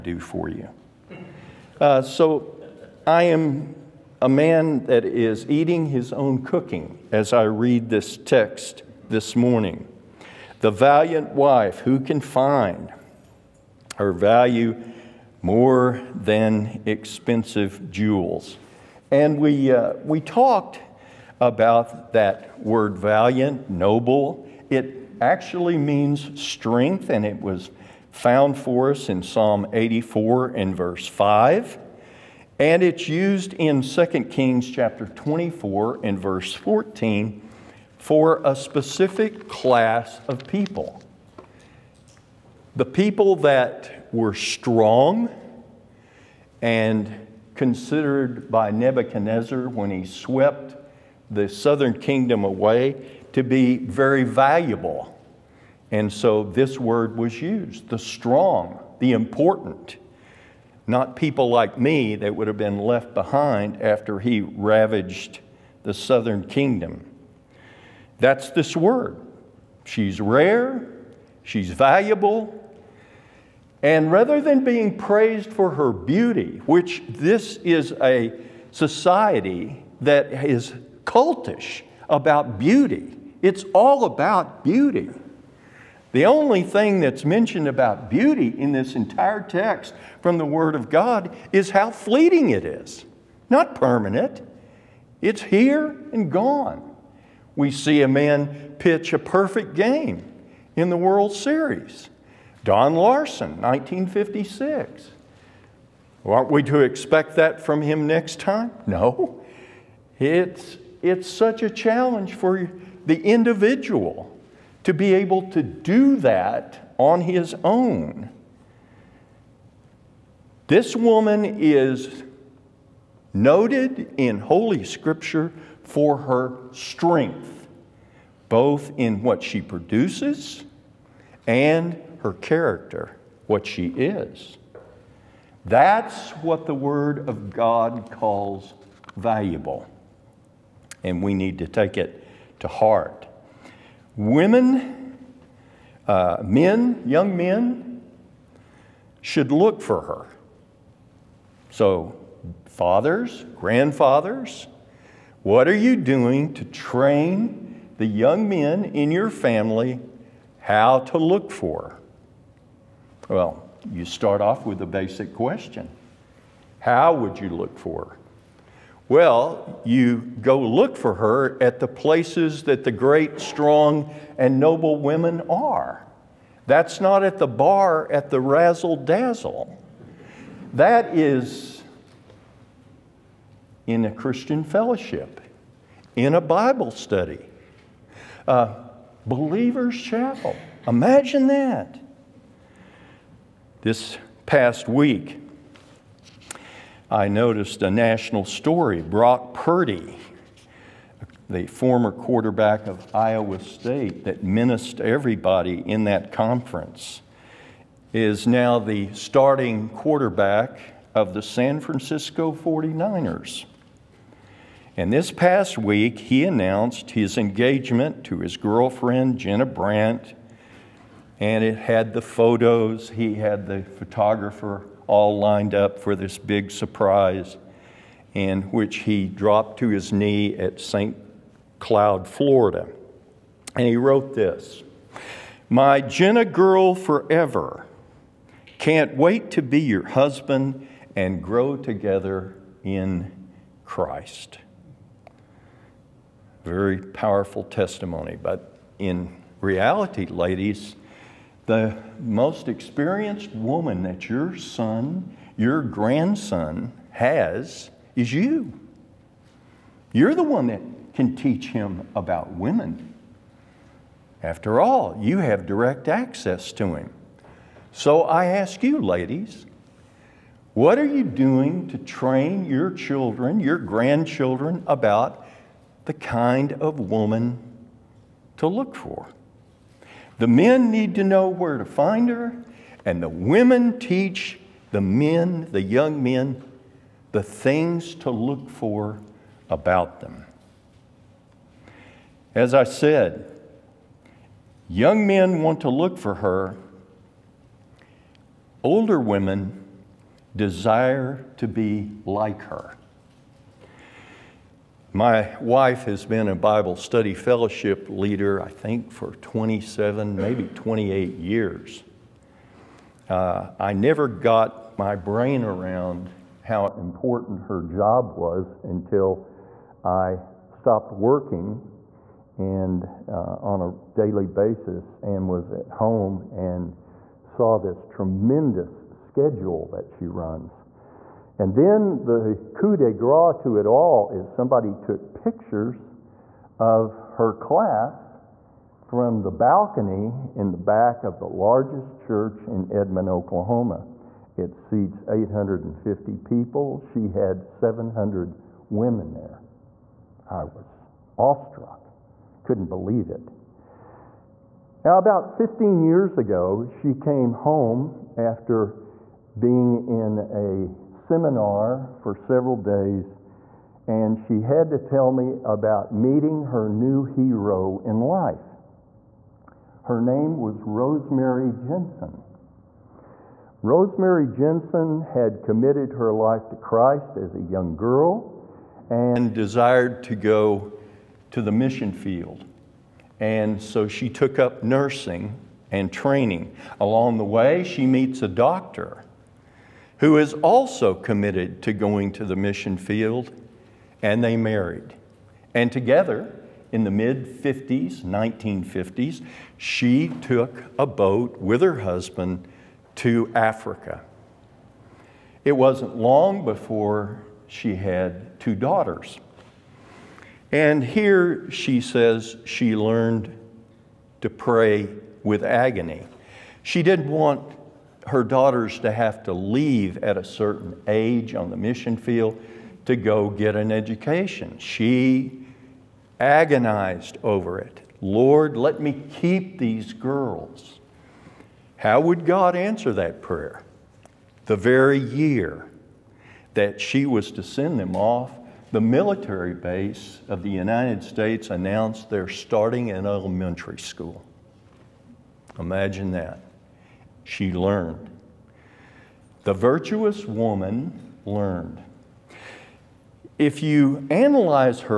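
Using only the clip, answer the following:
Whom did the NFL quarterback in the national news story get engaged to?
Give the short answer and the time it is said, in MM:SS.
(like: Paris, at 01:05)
Jenna Brandt, at 03:39.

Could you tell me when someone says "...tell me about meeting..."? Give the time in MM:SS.
06:04.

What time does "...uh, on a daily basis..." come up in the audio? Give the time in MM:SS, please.
05:23.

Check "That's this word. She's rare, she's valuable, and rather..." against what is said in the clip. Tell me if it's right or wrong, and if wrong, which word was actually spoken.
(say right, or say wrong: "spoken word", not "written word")
right.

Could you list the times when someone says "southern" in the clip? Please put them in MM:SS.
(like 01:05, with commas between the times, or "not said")
00:51, 01:05.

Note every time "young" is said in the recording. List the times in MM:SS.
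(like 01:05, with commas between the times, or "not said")
02:27, 02:38, 04:45, 04:54, 06:17.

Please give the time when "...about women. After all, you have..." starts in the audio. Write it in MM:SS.
04:22.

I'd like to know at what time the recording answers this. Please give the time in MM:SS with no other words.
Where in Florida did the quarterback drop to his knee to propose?
03:50.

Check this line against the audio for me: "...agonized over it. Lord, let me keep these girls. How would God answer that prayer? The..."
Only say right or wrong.
right.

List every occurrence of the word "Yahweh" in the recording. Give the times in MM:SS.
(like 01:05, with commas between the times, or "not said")
not said.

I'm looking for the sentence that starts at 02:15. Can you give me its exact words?
That's what the Word of God calls valuable.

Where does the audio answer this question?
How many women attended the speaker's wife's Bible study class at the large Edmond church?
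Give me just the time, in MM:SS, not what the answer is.
05:47.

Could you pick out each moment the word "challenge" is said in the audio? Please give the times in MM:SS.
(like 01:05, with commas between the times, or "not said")
01:51.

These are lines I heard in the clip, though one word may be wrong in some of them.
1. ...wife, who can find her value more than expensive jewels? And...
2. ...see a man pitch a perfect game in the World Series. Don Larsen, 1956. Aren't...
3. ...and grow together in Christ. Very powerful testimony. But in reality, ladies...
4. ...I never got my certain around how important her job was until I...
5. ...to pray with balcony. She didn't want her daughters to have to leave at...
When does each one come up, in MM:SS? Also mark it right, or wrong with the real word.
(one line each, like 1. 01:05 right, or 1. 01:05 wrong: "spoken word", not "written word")
1. 00:11 right
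2. 01:37 right
3. 04:01 right
4. 05:13 wrong: "brain", not "certain"
5. 06:54 wrong: "agony", not "balcony".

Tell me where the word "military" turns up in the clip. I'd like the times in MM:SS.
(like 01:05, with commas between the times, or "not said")
07:19.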